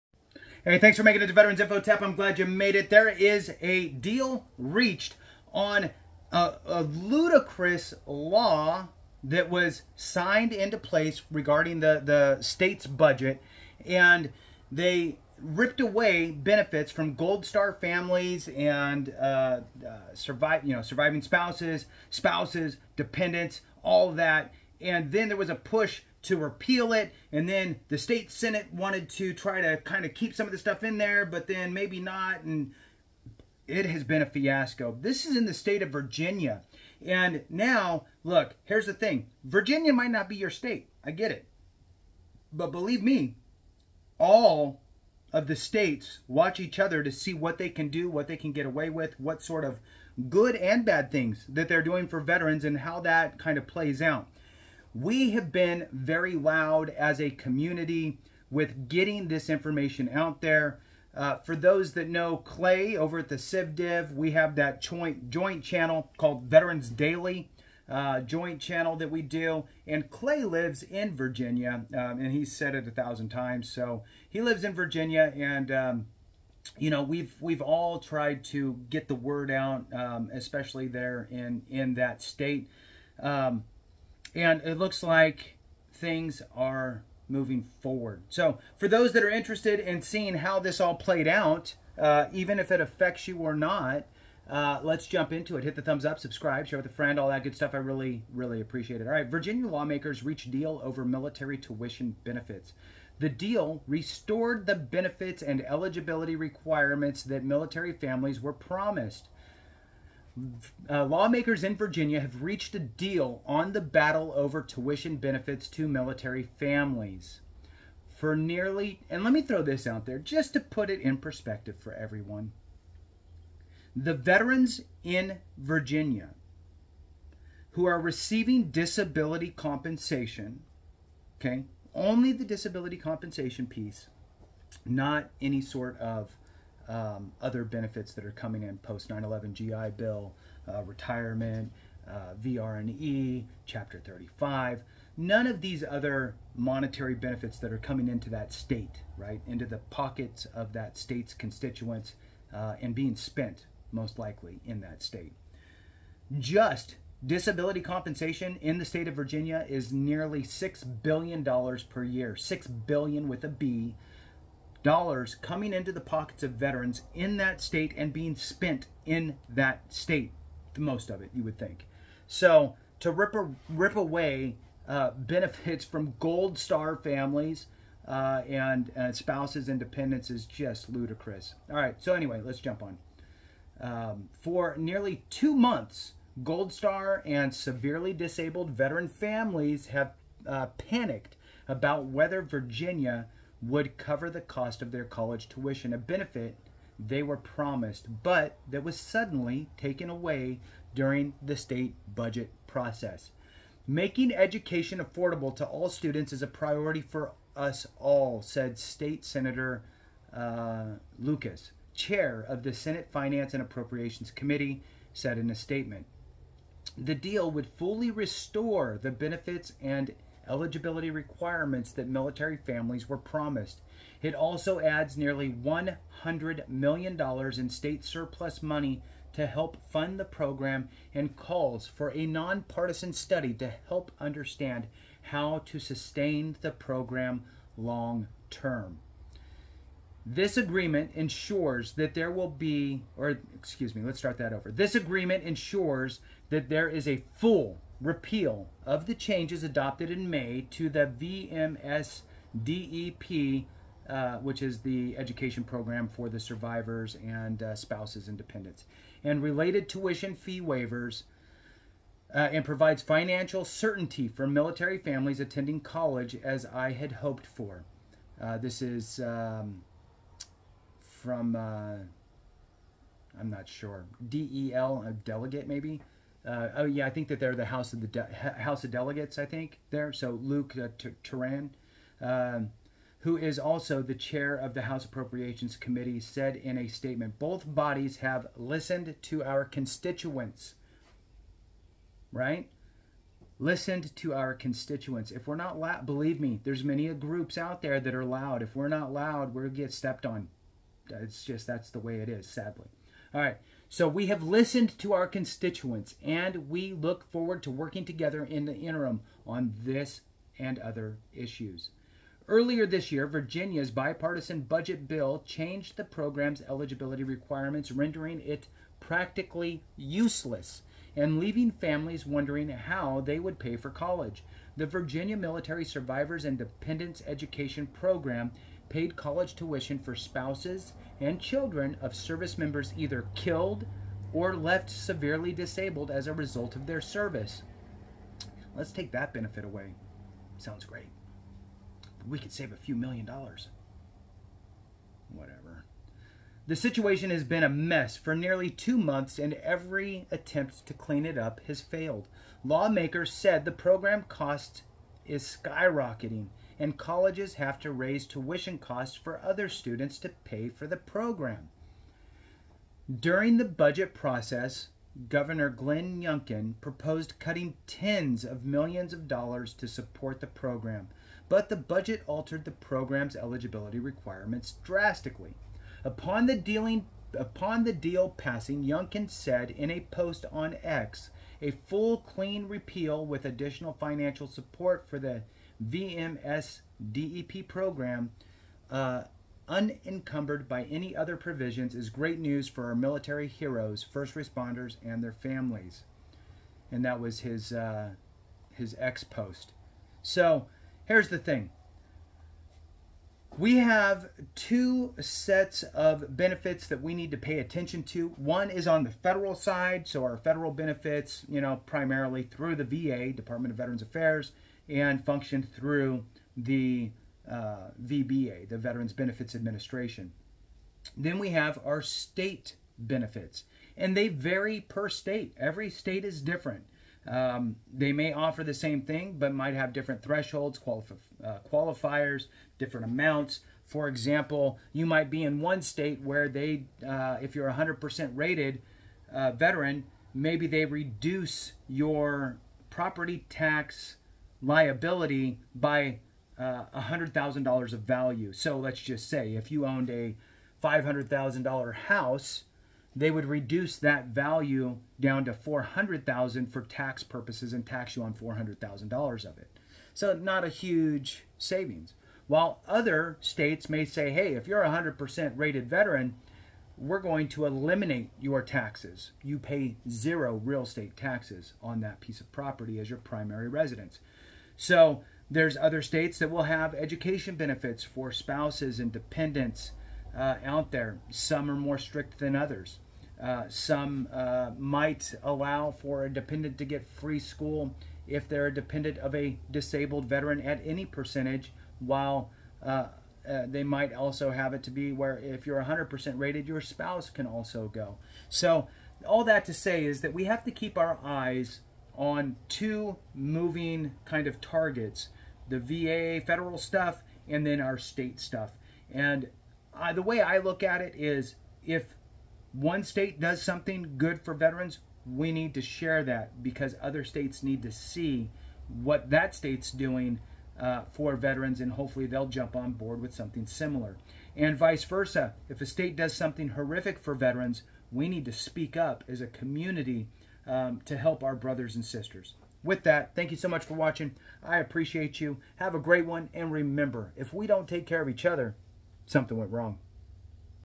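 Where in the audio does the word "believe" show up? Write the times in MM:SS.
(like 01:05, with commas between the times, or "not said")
00:42, 04:56.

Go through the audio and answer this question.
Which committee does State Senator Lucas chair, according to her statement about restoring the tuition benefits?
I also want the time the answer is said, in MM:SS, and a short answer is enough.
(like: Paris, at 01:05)
Senate Finance and Appropriations Committee, at 03:32.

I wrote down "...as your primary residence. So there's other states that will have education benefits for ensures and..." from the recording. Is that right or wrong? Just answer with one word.
wrong.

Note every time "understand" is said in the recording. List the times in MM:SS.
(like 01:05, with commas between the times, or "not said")
03:54.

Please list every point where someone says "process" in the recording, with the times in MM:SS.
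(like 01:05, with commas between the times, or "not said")
03:22, 06:04.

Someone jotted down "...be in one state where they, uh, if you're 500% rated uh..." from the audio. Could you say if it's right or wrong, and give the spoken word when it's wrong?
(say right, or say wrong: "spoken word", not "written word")
wrong: "100", not "500".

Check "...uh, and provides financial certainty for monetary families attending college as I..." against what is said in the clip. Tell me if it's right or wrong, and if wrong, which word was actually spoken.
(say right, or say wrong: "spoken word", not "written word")
wrong: "military", not "monetary".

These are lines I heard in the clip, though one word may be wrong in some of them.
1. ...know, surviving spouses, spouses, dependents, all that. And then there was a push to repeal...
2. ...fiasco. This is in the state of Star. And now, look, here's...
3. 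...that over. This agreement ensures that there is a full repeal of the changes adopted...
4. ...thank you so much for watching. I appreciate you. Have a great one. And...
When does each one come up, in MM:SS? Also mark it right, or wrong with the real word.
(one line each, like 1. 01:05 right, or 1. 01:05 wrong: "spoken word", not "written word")
1. 00:20 right
2. 00:34 wrong: "Virginia", not "Star"
3. 04:04 right
4. 08:53 right.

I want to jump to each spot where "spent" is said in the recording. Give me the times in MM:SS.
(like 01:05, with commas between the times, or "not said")
02:33, 02:48.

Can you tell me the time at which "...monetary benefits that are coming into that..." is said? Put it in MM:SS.
02:26.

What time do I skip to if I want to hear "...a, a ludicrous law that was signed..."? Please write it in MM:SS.
00:06.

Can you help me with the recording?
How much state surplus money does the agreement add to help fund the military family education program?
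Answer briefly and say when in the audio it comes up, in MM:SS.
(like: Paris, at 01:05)
nearly $100 million, at 03:45.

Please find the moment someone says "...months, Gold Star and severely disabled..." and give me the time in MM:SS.
03:05.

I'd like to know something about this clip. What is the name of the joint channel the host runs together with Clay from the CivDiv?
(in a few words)
Veterans Daily.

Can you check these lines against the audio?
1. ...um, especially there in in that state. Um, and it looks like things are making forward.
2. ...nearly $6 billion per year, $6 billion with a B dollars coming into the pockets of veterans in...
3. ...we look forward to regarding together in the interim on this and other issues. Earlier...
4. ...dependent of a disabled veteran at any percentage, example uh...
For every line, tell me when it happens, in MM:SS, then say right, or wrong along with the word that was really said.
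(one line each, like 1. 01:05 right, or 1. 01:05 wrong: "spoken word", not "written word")
1. 01:19 wrong: "moving", not "making"
2. 02:39 right
3. 05:06 wrong: "working", not "regarding"
4. 08:08 wrong: "while", not "example".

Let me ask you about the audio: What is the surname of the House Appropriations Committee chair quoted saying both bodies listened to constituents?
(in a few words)
Torian.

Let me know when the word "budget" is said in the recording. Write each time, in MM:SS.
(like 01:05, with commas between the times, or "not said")
00:12, 03:22, 05:14, 06:03, 06:11.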